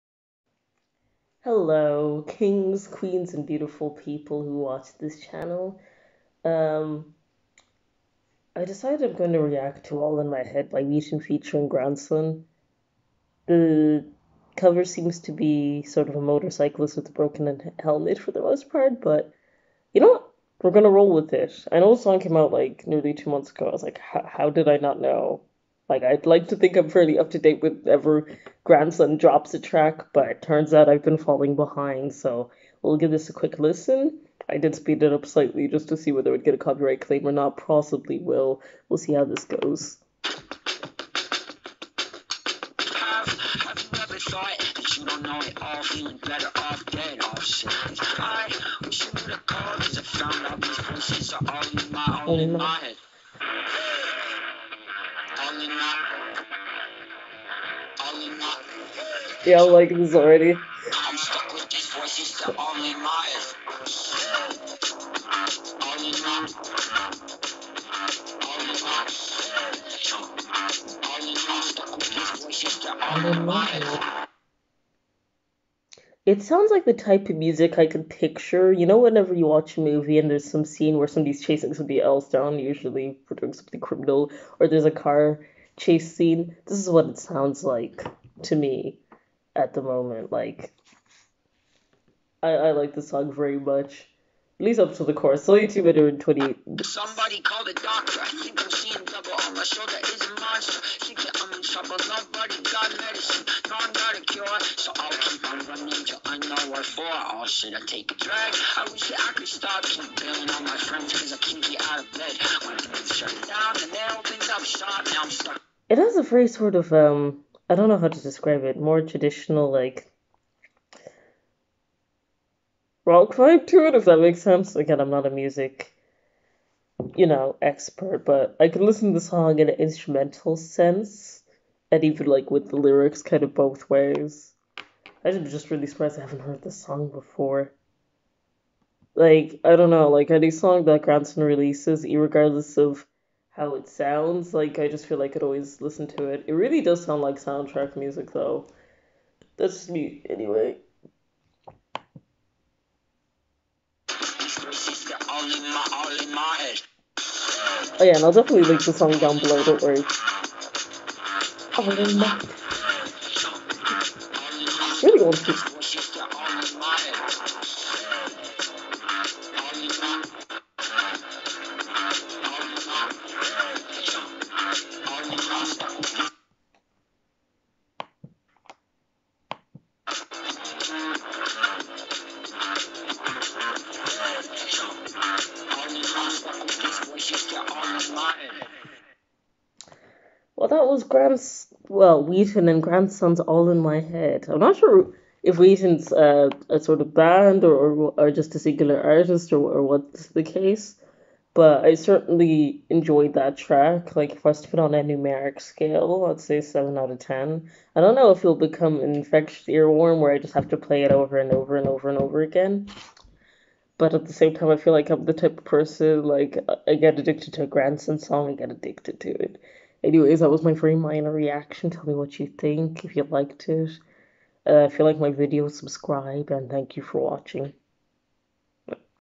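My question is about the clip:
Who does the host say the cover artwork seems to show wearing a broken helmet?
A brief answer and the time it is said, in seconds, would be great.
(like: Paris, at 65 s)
a motorcyclist, at 16 s.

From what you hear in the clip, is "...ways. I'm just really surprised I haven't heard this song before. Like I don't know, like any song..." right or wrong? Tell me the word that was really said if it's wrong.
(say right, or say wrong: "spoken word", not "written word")
right.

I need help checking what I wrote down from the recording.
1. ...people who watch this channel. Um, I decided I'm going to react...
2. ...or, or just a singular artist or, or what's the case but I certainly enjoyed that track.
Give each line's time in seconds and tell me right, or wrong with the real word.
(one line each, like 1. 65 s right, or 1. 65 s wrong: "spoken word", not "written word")
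1. 3 s right
2. 197 s right.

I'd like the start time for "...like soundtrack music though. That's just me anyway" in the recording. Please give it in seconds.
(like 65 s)
147 s.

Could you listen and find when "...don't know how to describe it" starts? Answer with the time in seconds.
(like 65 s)
117 s.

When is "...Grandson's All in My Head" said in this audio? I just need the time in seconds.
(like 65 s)
192 s.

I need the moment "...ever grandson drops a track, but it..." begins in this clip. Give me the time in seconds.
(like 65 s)
27 s.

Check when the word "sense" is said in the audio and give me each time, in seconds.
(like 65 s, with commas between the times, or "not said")
124 s, 130 s.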